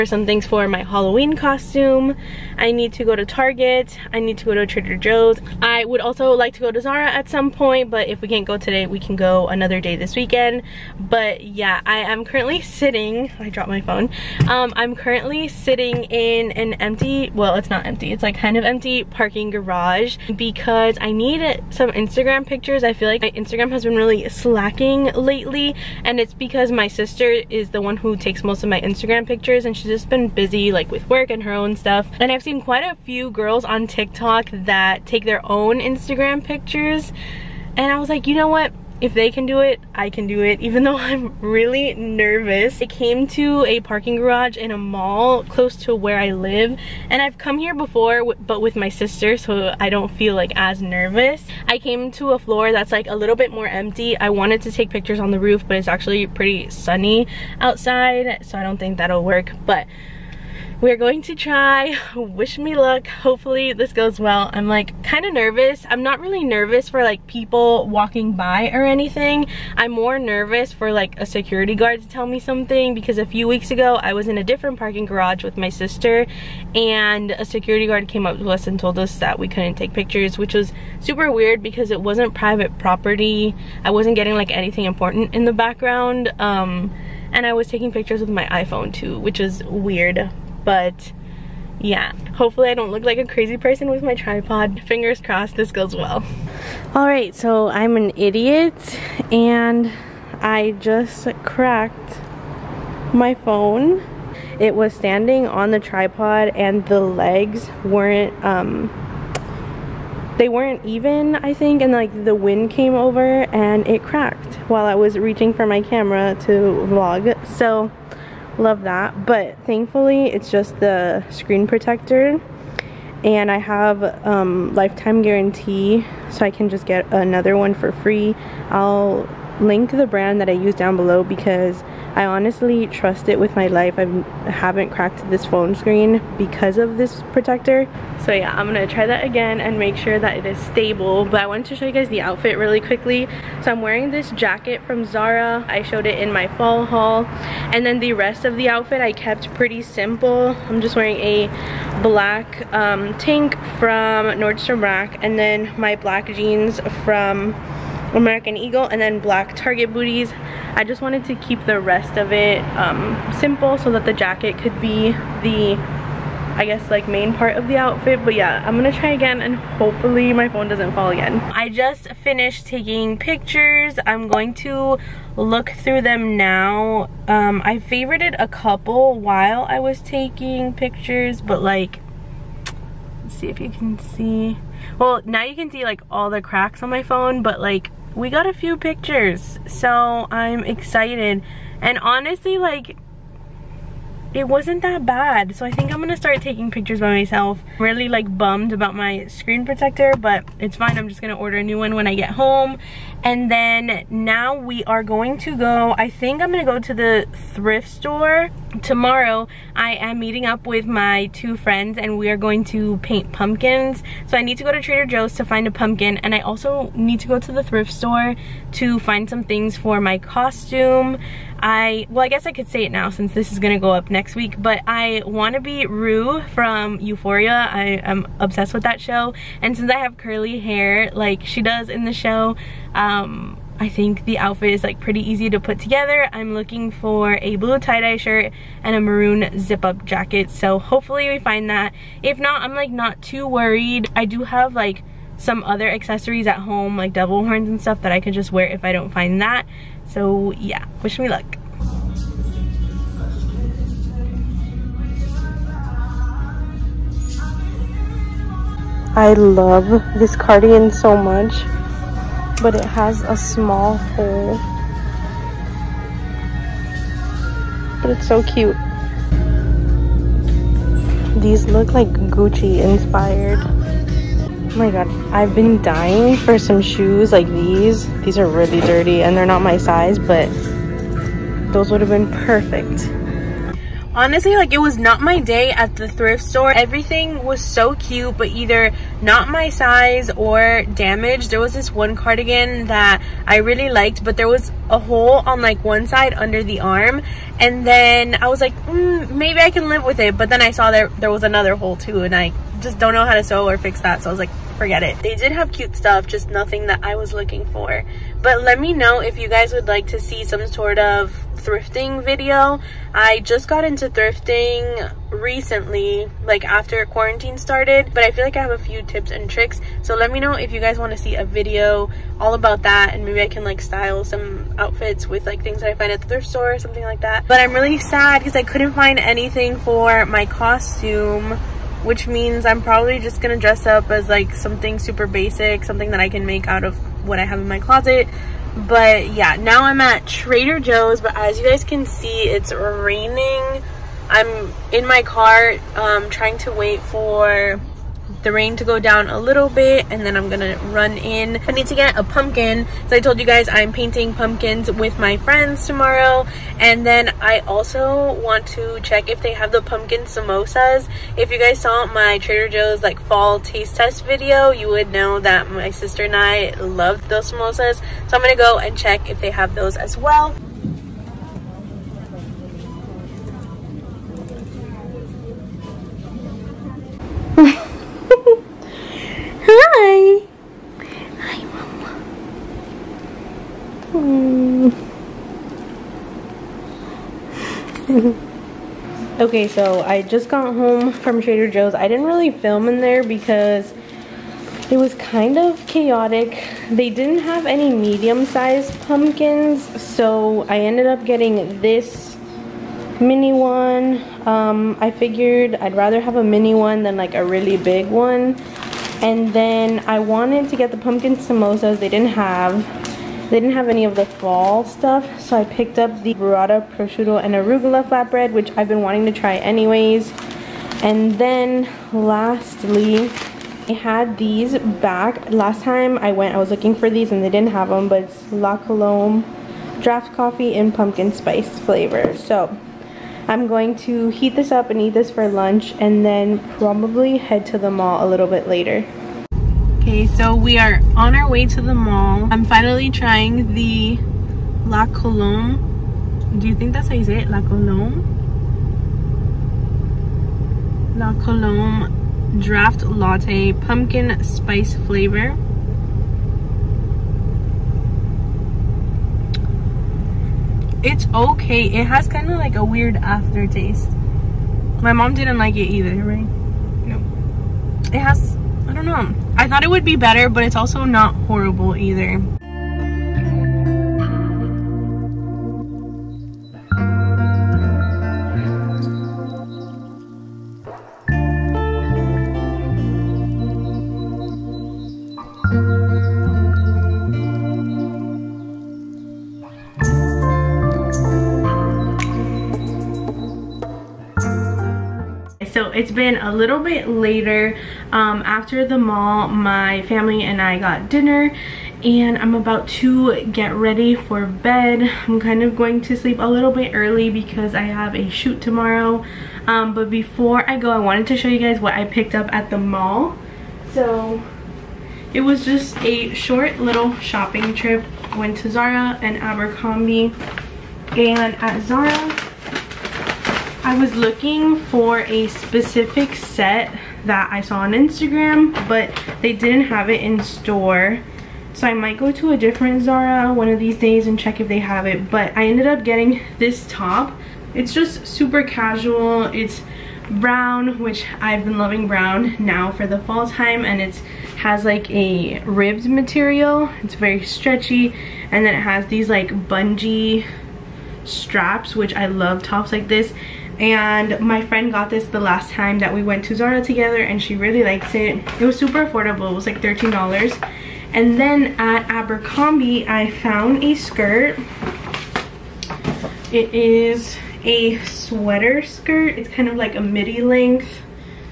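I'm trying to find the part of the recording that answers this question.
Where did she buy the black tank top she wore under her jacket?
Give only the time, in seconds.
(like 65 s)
154 s.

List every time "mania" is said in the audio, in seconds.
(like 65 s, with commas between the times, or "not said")
not said.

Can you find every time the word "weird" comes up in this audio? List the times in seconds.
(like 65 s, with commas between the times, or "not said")
81 s, 89 s, 462 s.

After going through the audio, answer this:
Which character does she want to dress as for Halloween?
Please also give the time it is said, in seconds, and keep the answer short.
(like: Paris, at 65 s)
Rue, at 225 s.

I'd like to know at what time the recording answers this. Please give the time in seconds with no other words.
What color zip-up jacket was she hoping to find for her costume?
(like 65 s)
238 s.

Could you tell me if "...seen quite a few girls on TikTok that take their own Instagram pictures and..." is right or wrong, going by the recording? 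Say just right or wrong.
right.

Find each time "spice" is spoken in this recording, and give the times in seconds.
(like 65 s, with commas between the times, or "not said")
431 s, 454 s.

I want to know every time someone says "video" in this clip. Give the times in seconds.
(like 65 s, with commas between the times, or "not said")
312 s, 321 s, 364 s.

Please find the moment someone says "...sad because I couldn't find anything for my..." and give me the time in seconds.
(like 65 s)
327 s.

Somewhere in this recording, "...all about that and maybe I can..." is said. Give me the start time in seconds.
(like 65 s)
322 s.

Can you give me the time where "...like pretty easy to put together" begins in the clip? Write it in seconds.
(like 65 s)
234 s.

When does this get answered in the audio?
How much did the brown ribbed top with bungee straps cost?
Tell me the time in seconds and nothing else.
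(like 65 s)
559 s.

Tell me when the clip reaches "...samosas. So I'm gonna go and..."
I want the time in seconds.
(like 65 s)
367 s.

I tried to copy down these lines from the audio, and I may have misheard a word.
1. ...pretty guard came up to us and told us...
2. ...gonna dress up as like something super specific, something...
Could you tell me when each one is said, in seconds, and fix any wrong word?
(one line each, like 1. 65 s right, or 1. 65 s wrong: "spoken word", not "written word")
1. 77 s wrong: "security", not "pretty"
2. 333 s wrong: "basic", not "specific".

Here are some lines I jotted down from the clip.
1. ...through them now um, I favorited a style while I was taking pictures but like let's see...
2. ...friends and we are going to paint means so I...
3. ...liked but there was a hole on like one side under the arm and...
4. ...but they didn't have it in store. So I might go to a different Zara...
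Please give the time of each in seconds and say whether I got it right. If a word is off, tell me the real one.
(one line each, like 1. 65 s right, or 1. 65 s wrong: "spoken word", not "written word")
1. 175 s wrong: "couple", not "style"
2. 211 s wrong: "pumpkins", not "means"
3. 293 s right
4. 528 s right.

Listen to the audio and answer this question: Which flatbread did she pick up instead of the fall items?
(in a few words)
Burrata, prosciutto, and arugula.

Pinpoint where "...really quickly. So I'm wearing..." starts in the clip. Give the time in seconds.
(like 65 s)
142 s.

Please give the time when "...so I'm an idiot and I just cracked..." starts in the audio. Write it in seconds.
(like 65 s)
97 s.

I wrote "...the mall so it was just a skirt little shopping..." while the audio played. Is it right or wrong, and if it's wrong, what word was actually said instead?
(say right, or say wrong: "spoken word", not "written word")
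wrong: "short", not "skirt".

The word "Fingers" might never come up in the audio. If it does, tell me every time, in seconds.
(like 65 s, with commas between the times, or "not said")
94 s.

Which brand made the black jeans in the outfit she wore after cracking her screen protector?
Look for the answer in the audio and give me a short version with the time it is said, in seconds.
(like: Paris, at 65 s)
American Eagle, at 158 s.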